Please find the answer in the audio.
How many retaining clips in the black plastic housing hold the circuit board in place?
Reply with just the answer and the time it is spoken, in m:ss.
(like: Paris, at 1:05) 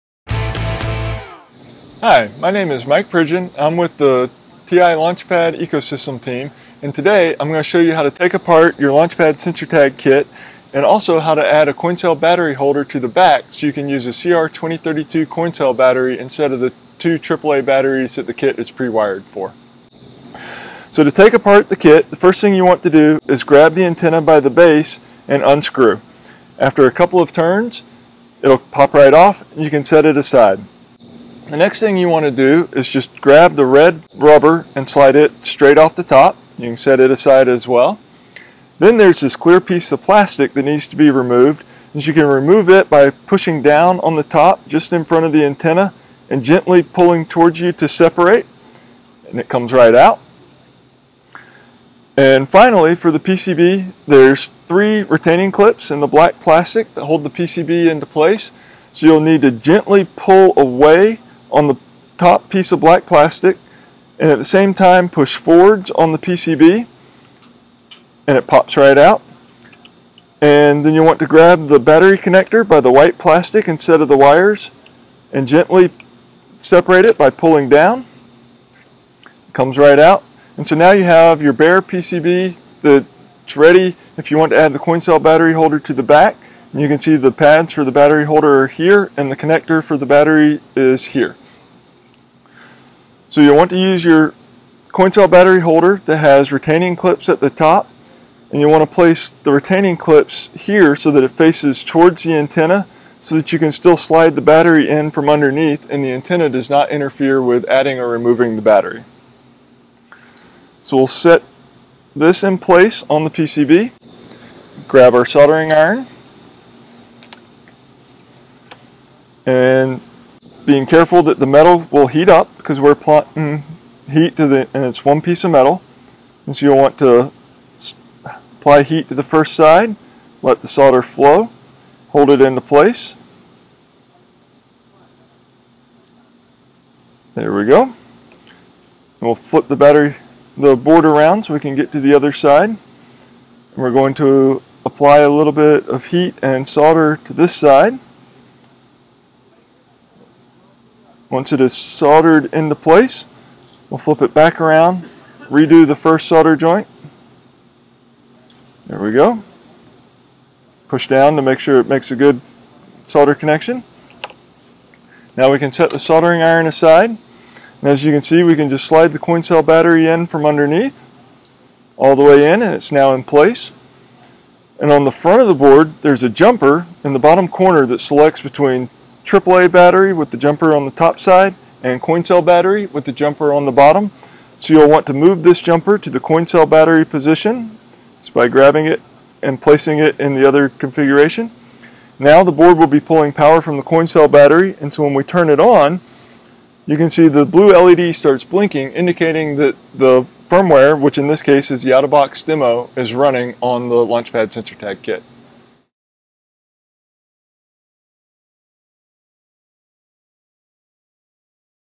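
3, at 0:54.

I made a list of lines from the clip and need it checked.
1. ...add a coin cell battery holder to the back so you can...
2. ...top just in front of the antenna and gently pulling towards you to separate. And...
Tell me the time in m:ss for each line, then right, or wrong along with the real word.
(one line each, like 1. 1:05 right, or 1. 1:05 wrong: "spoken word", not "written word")
1. 0:11 right
2. 0:44 right.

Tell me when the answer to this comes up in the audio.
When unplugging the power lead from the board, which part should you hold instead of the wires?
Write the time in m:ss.
1:12.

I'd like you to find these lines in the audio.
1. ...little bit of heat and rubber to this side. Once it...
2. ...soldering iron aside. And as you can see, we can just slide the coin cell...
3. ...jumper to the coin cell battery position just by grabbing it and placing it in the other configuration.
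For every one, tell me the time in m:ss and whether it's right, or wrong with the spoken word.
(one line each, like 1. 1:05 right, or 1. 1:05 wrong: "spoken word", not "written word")
1. 2:25 wrong: "solder", not "rubber"
2. 2:45 right
3. 3:05 right.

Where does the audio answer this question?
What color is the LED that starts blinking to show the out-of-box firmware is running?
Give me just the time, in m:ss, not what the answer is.
3:17.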